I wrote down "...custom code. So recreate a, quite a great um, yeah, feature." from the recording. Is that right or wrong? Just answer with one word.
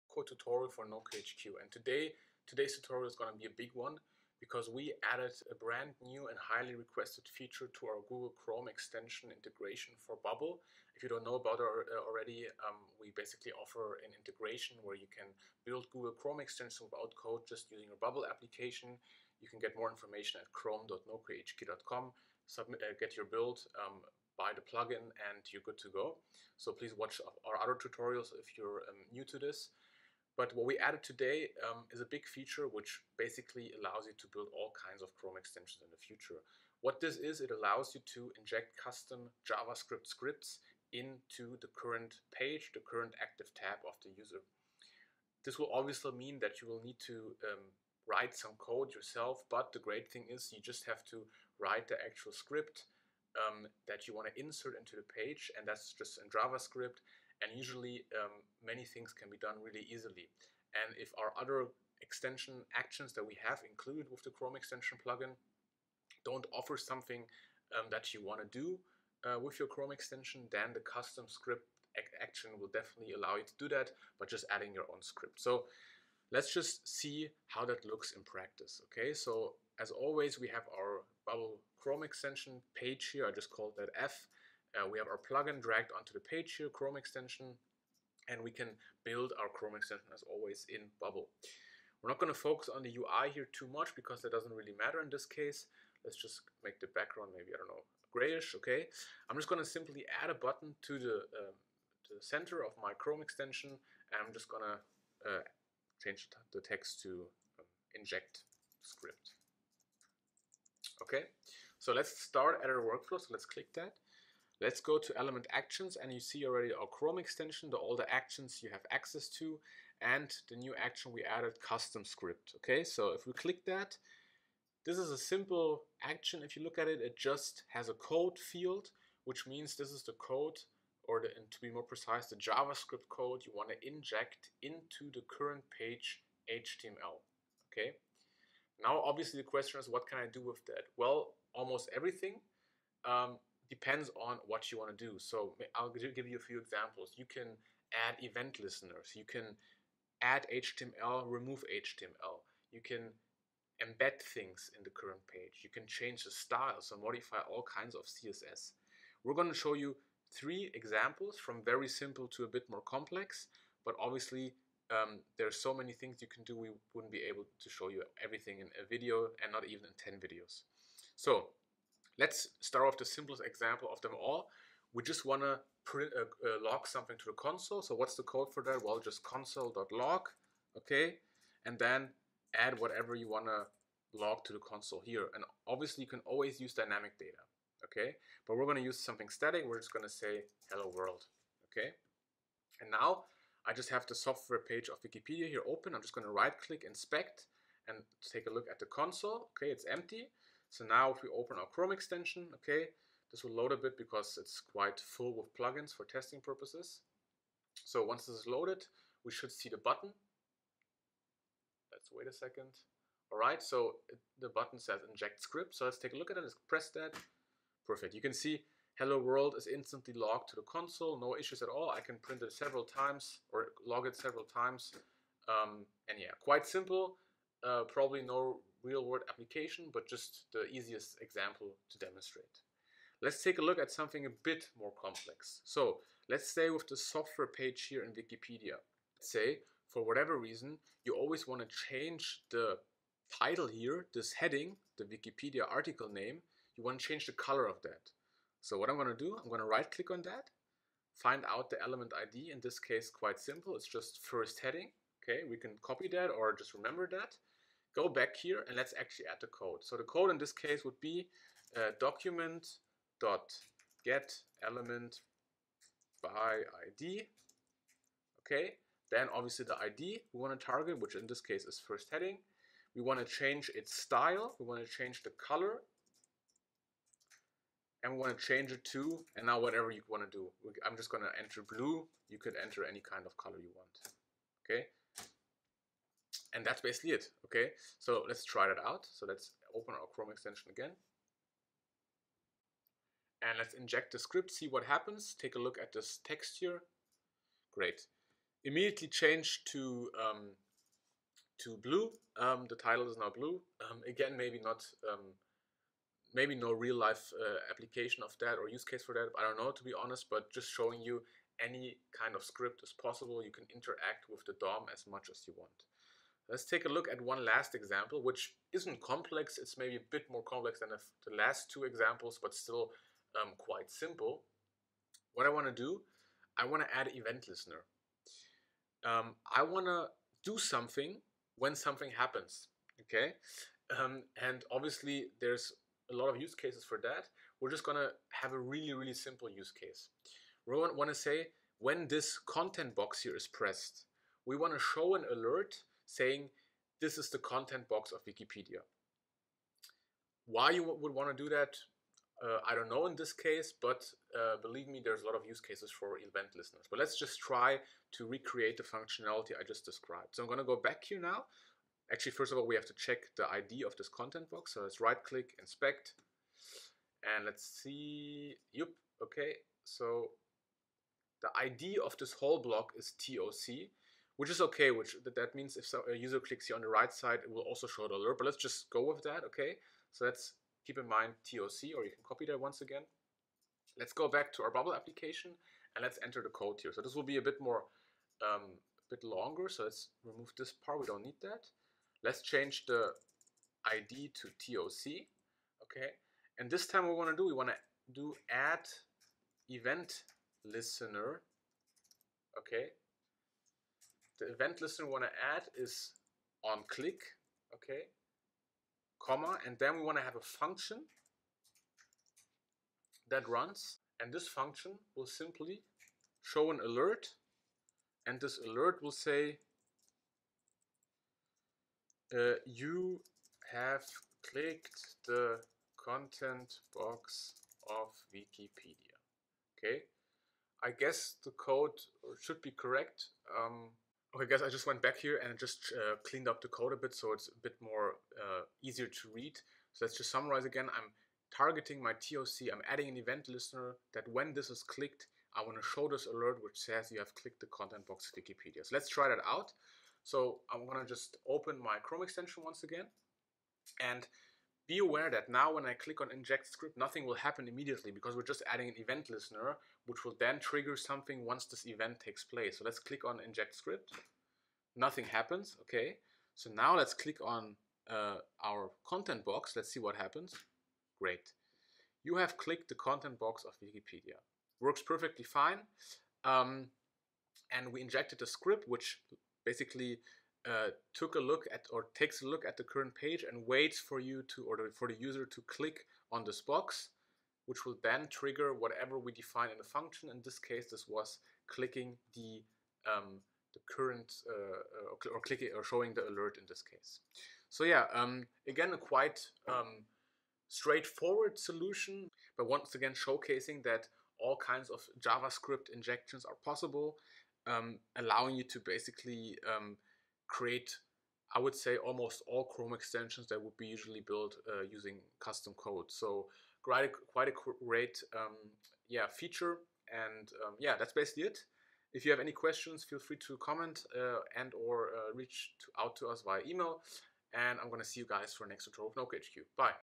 wrong.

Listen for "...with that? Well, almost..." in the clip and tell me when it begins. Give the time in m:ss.
2:20.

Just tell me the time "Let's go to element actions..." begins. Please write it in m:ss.
1:54.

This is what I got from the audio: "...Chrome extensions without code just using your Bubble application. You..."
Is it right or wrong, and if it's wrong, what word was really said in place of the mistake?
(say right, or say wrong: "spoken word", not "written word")
right.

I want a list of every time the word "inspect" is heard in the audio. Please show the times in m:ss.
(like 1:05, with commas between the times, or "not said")
3:16, 6:05.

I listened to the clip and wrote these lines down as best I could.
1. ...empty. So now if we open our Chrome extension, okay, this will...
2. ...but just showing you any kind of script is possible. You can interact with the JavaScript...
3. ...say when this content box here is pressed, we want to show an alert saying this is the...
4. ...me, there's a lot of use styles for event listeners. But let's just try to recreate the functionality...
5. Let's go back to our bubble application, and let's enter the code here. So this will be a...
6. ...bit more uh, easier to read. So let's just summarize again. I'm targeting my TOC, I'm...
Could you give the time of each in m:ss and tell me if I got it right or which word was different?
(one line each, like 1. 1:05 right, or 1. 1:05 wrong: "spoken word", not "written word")
1. 3:19 right
2. 5:10 wrong: "DOM", not "JavaScript"
3. 5:41 right
4. 5:54 wrong: "cases", not "styles"
5. 6:23 right
6. 7:17 right.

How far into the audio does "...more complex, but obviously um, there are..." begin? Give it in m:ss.
2:42.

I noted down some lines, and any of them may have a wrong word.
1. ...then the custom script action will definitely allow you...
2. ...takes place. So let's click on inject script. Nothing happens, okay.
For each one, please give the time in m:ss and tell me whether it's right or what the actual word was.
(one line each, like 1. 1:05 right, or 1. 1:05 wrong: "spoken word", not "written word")
1. 1:10 right
2. 7:42 right.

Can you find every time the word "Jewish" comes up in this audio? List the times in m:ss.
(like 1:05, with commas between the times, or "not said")
not said.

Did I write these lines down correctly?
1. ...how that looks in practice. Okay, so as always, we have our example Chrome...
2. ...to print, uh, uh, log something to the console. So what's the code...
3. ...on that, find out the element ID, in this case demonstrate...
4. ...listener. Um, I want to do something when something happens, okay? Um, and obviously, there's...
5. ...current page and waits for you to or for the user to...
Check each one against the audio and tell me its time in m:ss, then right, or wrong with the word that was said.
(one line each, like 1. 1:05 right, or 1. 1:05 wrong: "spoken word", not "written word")
1. 1:17 wrong: "bubble", not "example"
2. 2:55 right
3. 4:10 wrong: "quite", not "demonstrate"
4. 5:27 right
5. 8:02 right.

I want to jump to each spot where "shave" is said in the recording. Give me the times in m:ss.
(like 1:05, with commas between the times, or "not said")
not said.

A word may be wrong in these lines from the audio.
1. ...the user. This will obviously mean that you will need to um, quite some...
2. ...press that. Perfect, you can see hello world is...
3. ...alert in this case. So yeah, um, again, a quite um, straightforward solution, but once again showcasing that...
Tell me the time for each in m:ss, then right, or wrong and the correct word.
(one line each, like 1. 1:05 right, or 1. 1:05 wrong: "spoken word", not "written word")
1. 0:44 wrong: "write", not "quite"
2. 3:36 right
3. 8:16 right.